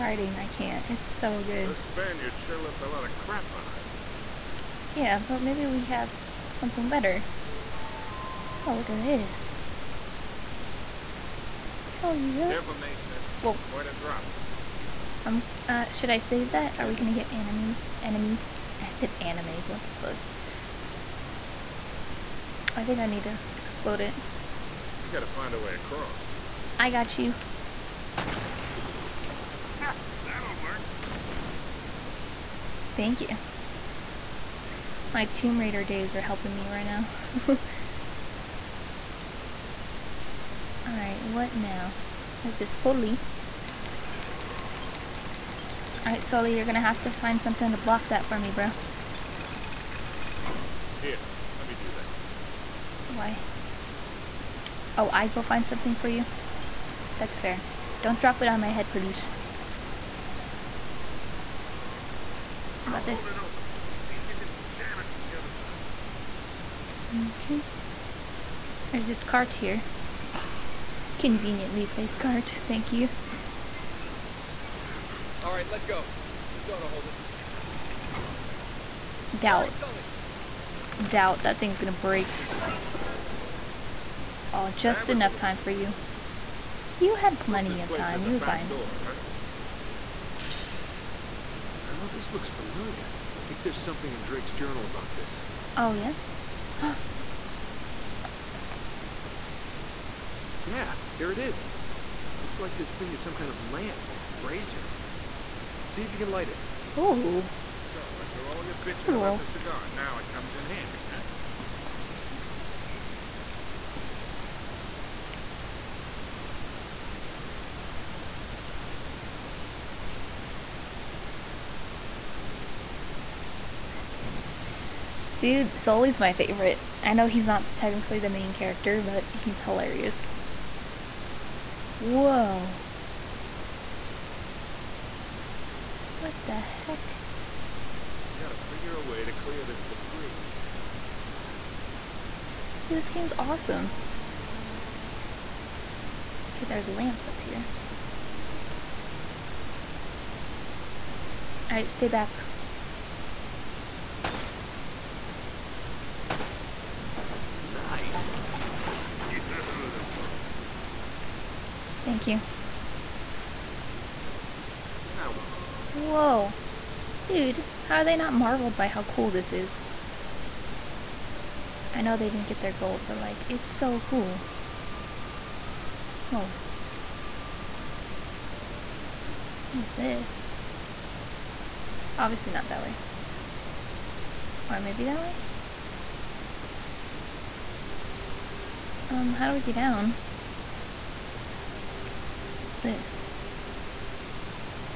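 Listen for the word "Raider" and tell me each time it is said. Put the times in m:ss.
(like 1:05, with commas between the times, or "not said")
0:35.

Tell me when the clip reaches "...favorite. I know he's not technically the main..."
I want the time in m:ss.
2:06.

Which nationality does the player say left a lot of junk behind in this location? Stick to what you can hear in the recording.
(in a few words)
Spaniards.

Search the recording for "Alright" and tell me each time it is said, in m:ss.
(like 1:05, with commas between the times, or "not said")
0:40, 0:46, 2:31.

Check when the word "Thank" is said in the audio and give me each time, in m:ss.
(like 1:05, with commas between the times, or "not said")
0:32, 1:12, 2:42.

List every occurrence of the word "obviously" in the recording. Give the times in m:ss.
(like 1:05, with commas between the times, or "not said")
3:02.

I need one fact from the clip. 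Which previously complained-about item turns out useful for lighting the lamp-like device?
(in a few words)
cigar.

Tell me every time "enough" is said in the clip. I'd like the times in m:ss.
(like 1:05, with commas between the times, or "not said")
1:25.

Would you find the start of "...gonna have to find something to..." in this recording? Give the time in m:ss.
0:46.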